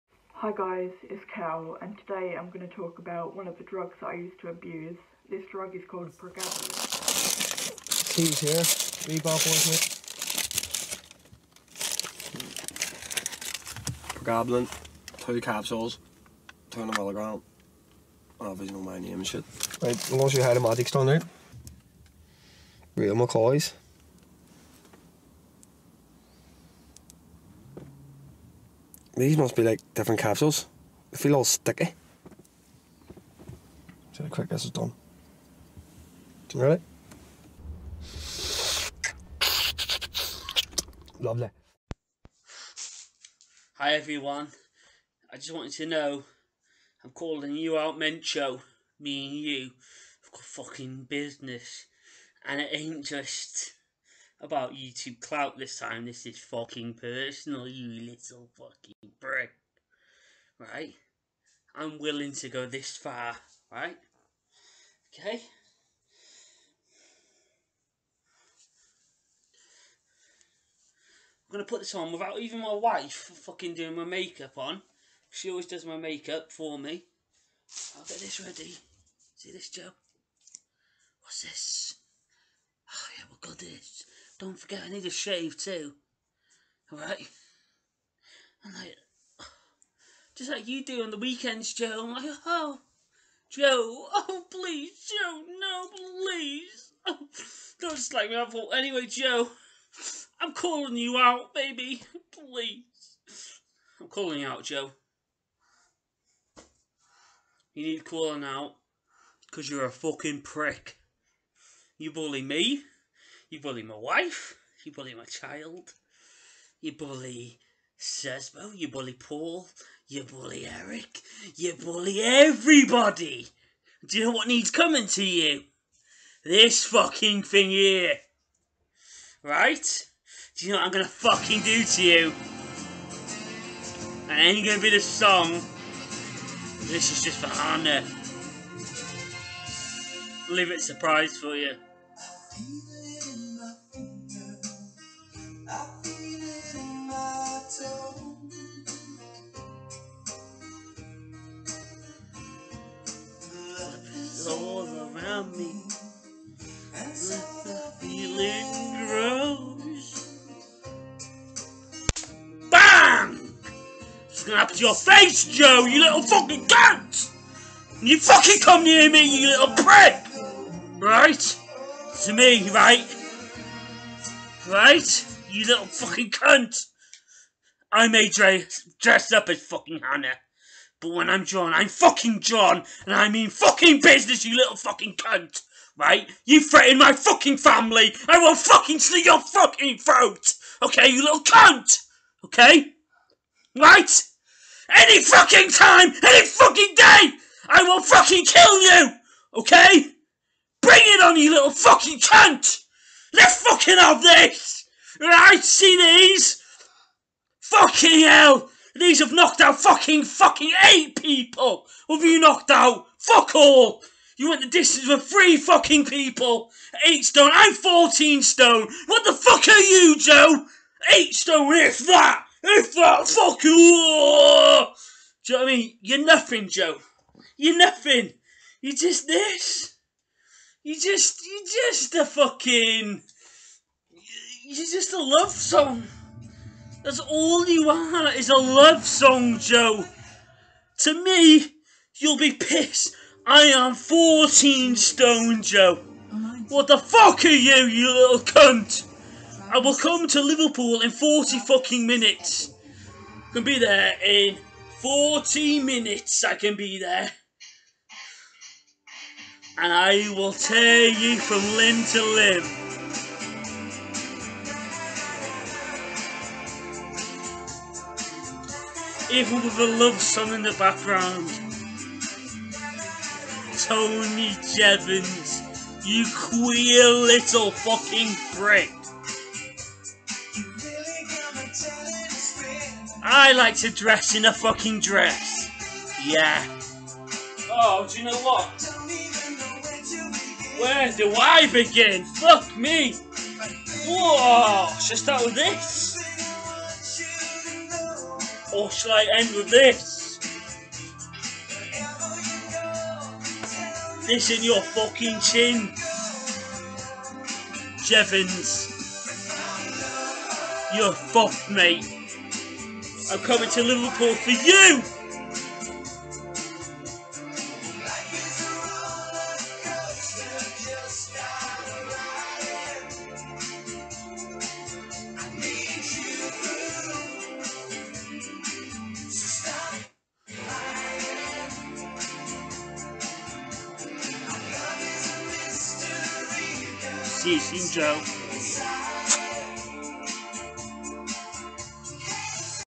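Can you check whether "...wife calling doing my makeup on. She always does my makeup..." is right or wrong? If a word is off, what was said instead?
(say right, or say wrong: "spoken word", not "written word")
wrong: "fucking", not "calling".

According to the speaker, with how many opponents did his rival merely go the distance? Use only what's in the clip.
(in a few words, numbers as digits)
3.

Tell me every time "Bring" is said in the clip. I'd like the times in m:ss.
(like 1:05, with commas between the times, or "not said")
3:20.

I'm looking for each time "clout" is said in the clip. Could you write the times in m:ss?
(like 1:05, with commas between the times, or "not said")
0:55.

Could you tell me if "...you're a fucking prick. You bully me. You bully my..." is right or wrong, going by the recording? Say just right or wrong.
right.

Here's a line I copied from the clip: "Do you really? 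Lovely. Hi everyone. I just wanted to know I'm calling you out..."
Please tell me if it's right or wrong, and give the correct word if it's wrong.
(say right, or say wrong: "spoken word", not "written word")
right.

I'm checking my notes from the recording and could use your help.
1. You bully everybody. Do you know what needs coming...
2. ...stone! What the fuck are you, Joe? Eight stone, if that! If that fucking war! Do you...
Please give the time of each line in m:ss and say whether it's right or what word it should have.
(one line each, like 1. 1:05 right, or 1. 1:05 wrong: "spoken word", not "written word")
1. 2:01 right
2. 3:38 right.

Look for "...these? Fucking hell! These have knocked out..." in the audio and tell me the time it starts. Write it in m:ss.
3:25.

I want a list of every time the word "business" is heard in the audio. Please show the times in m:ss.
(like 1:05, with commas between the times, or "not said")
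0:51, 3:04.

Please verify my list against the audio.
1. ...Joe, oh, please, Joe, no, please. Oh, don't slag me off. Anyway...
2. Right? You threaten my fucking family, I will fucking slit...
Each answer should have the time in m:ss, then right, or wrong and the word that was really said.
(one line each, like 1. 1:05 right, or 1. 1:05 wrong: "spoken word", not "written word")
1. 1:33 right
2. 3:05 right.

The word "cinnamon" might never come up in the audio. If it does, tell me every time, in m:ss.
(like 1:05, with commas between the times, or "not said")
not said.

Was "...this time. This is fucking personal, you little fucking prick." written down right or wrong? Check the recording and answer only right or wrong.
right.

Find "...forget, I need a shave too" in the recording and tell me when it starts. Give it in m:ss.
1:24.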